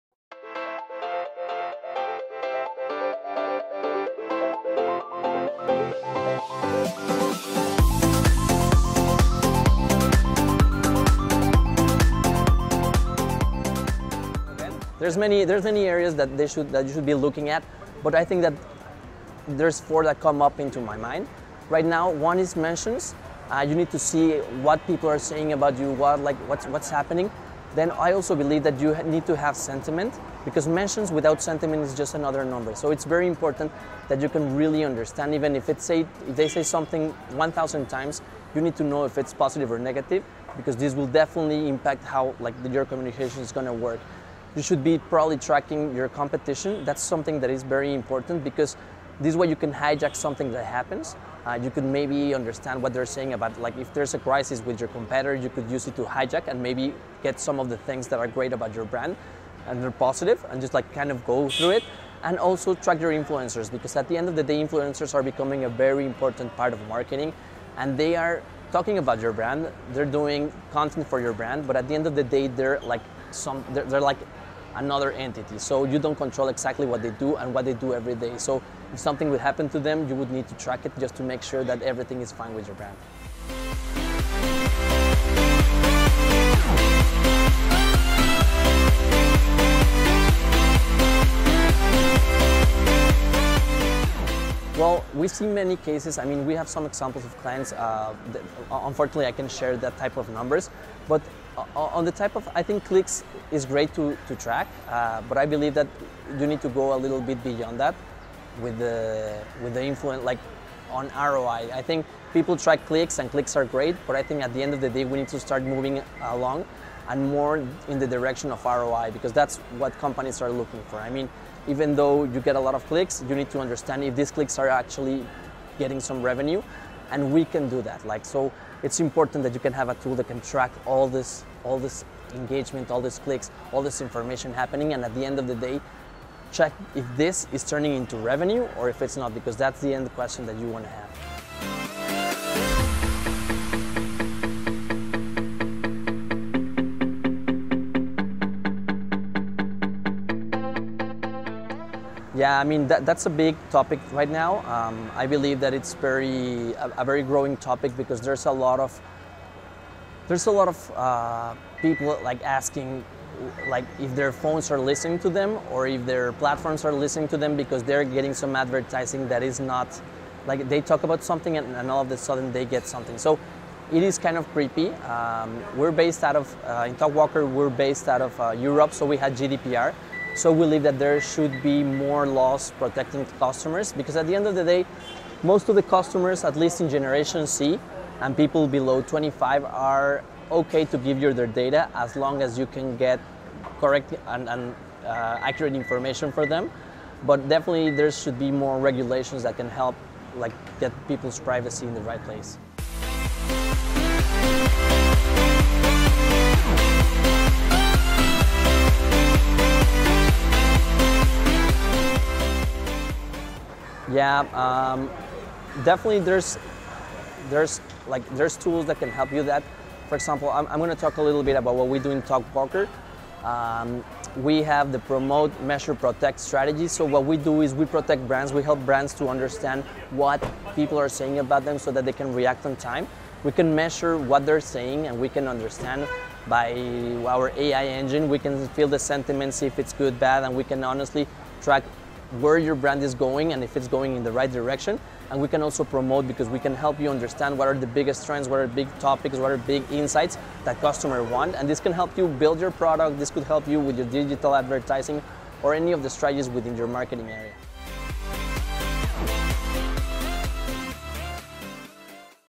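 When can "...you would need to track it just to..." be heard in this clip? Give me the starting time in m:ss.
1:20.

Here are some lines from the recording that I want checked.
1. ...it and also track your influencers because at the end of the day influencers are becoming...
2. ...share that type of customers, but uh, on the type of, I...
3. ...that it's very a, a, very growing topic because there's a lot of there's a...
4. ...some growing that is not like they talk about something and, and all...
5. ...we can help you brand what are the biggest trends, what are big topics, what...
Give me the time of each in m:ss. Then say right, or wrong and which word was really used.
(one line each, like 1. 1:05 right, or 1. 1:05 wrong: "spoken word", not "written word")
1. 1:01 right
2. 1:39 wrong: "numbers", not "customers"
3. 2:35 right
4. 2:48 wrong: "advertising", not "growing"
5. 4:06 wrong: "understand", not "brand".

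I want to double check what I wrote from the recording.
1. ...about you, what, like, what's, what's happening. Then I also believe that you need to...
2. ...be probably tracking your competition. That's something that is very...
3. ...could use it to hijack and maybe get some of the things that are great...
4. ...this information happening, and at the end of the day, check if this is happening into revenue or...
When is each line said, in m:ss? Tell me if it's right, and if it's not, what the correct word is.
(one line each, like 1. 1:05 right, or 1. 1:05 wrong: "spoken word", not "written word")
1. 0:25 right
2. 0:44 right
3. 0:55 right
4. 2:13 wrong: "turning", not "happening".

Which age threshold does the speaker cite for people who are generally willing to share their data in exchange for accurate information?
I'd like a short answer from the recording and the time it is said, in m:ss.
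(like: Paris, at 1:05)
25, at 3:09.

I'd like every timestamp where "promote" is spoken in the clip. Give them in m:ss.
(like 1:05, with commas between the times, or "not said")
3:44, 4:05.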